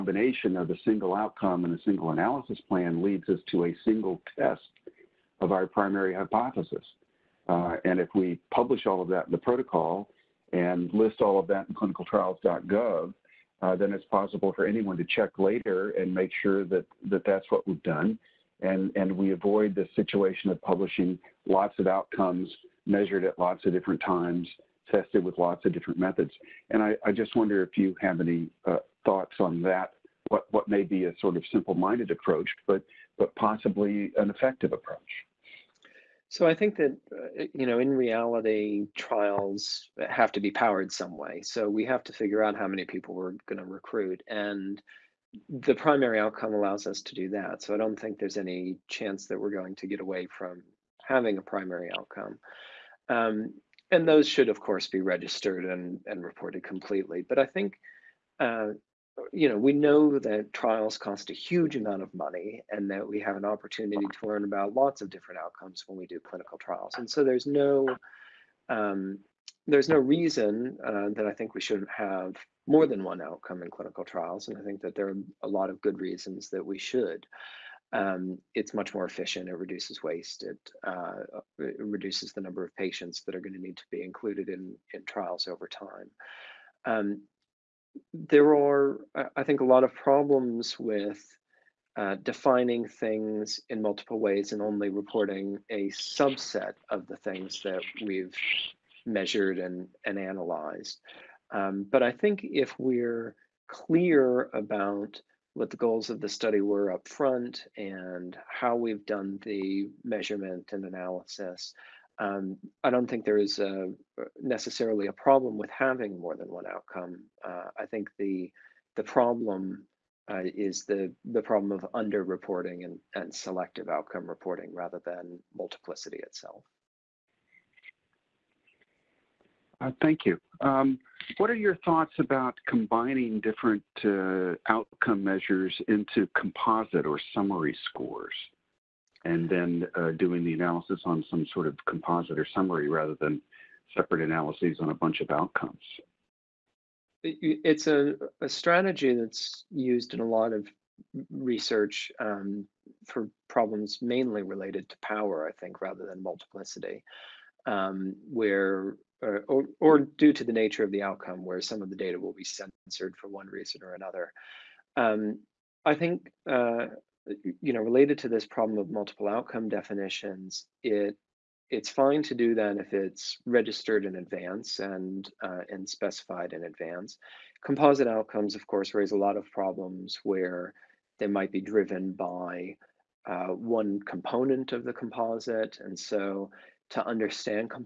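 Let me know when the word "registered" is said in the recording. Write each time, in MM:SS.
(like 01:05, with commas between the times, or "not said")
00:55, 02:53.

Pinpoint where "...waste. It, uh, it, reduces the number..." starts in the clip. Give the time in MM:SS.
01:20.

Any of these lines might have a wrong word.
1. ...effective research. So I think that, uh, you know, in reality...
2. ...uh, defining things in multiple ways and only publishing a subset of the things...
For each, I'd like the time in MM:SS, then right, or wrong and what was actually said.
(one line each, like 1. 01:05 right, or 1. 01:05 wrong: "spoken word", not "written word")
1. 00:34 wrong: "approach", not "research"
2. 01:31 wrong: "reporting", not "publishing".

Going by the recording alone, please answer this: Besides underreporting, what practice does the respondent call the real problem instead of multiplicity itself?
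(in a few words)
Selective outcome reporting.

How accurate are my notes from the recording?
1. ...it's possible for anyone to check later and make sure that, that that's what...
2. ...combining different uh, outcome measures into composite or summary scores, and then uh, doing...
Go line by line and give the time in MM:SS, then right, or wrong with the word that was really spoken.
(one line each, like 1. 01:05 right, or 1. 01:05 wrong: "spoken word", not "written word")
1. 00:13 right
2. 02:12 right.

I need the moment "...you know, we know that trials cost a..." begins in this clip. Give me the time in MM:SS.
00:59.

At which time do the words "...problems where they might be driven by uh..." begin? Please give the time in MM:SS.
02:59.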